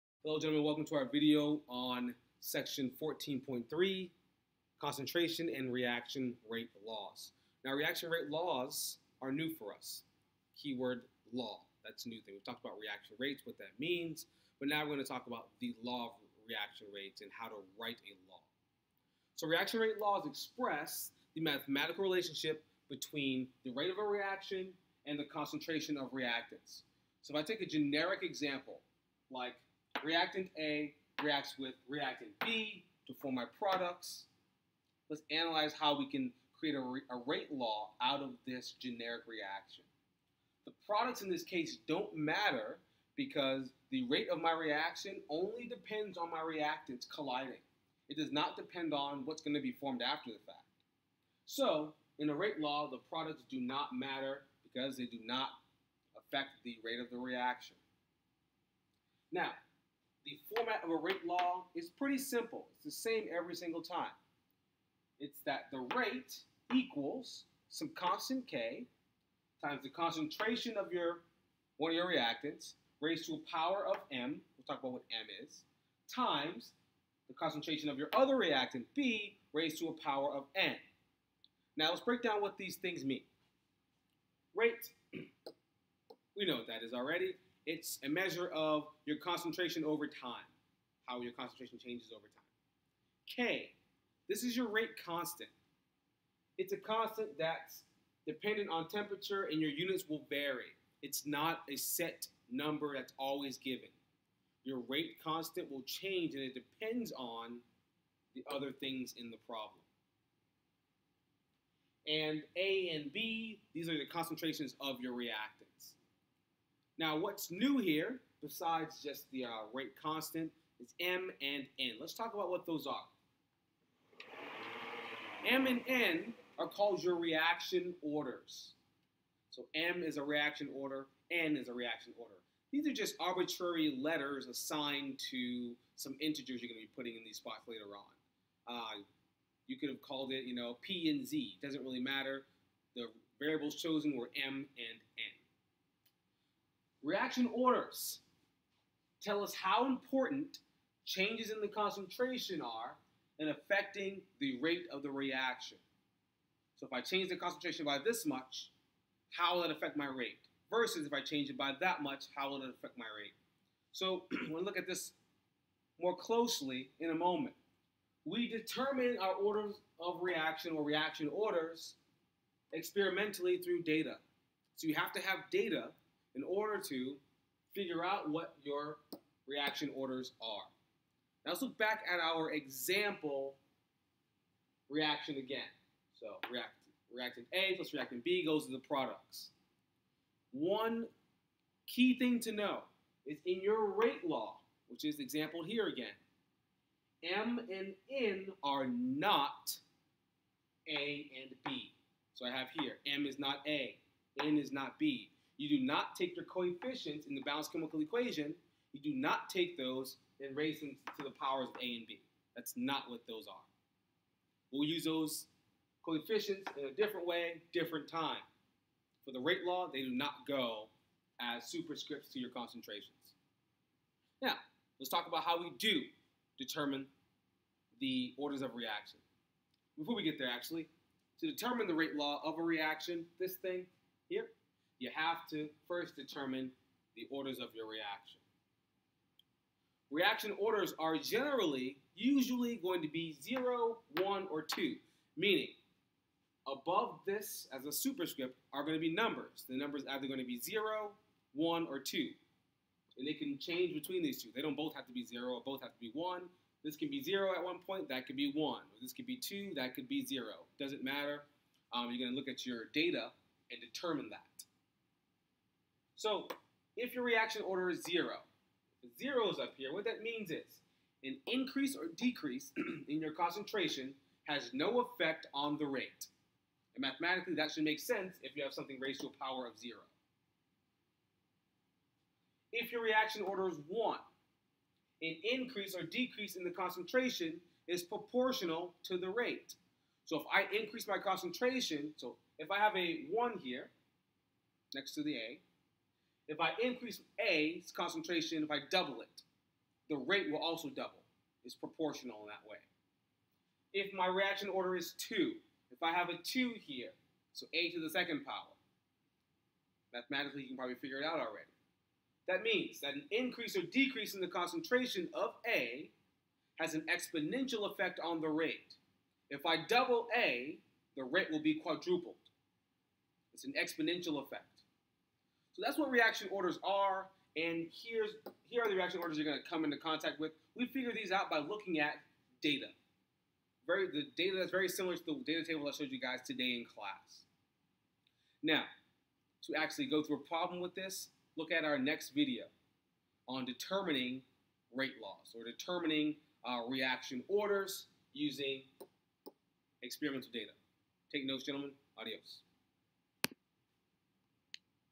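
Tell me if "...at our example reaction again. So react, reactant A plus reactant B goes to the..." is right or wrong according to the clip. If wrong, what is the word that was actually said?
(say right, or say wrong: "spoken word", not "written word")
right.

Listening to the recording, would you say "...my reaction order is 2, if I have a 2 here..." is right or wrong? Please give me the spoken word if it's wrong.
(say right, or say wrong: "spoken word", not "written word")
right.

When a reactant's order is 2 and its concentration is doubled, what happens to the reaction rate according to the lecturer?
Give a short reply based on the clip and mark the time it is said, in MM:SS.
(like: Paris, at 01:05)
Quadrupled, at 05:21.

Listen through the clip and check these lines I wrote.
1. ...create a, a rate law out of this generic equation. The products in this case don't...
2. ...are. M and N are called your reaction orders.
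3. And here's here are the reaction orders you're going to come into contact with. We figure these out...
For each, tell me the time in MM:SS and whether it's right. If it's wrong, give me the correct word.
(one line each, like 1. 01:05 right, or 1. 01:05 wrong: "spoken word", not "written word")
1. 00:36 wrong: "reaction", not "equation"
2. 02:02 right
3. 05:27 right.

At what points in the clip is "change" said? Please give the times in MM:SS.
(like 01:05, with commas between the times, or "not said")
01:31, 01:45, 02:31, 02:37, 02:41, 04:13.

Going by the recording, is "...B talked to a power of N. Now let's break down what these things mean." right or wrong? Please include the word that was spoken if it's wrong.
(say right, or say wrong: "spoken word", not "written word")
wrong: "raised", not "talked".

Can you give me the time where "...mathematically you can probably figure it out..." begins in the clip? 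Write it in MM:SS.
05:10.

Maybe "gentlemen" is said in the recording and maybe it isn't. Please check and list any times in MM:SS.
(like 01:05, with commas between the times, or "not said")
00:00, 05:51.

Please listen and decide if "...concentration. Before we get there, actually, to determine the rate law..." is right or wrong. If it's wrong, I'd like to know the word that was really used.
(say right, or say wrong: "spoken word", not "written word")
wrong: "reaction", not "concentration".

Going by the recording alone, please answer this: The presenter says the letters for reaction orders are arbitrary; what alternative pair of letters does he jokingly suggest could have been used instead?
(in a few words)
P and Z.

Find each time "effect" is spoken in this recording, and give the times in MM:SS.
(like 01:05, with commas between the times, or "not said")
04:35, 05:17, 05:24.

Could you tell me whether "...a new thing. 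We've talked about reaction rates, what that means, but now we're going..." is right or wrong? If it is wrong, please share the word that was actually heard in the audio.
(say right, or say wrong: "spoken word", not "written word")
right.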